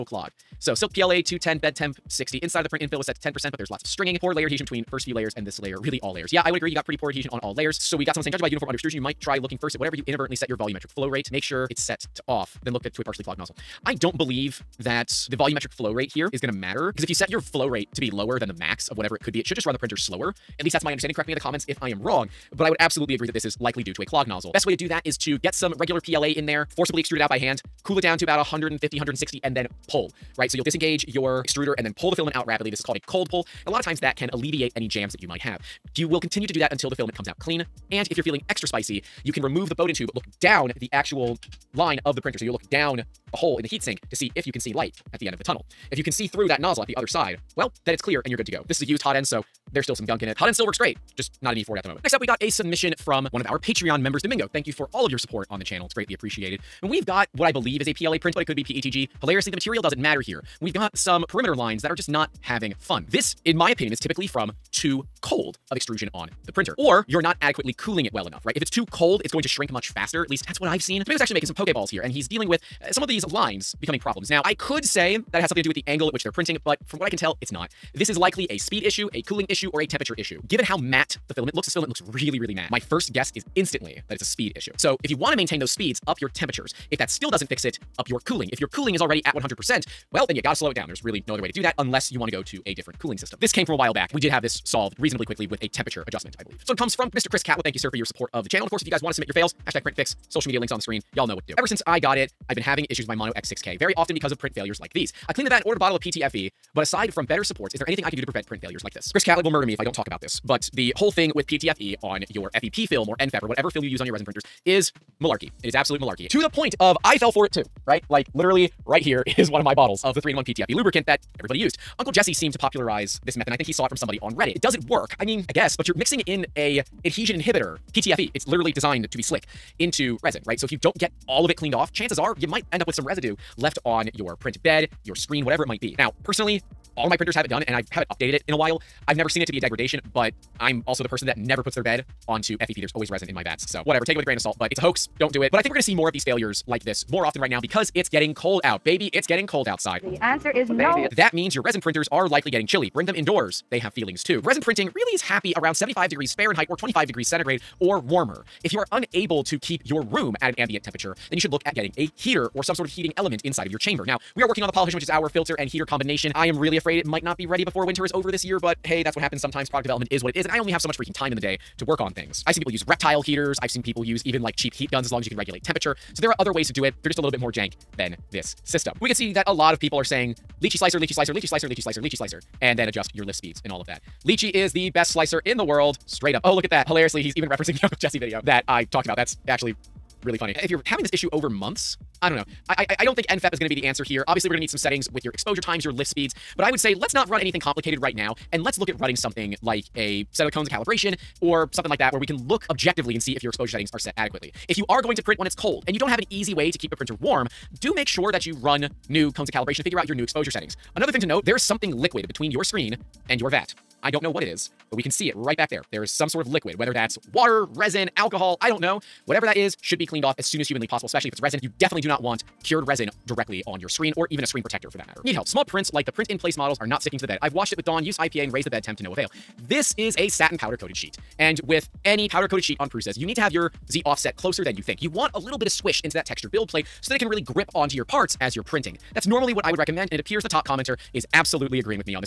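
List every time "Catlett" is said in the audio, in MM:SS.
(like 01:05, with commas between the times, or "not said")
01:37, 01:49.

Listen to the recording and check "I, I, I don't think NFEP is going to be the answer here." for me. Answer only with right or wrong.
right.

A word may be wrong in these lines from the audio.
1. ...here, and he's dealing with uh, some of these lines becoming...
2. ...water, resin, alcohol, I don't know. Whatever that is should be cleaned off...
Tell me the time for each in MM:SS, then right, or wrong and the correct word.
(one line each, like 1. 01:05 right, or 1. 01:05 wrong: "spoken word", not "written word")
1. 01:11 right
2. 03:37 right.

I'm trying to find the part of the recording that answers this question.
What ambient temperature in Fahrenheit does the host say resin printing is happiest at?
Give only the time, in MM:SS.
02:35.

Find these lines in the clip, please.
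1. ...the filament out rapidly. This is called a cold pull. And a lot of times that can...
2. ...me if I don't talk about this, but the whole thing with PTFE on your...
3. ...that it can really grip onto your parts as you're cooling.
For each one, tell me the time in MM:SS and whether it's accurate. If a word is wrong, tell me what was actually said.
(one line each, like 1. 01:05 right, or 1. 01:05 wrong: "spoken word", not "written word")
1. 00:32 right
2. 01:49 right
3. 03:57 wrong: "printing", not "cooling".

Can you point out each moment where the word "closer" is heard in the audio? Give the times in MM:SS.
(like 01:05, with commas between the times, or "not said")
03:54.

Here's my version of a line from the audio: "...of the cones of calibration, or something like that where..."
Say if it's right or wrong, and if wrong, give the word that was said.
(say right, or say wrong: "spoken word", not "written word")
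right.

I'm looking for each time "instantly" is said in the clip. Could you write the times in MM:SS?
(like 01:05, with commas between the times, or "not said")
01:23.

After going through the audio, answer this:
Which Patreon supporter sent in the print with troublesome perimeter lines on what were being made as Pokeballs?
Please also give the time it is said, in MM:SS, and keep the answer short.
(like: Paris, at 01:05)
Domingo, at 00:54.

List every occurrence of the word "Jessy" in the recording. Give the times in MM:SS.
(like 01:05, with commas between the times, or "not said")
02:02, 03:07.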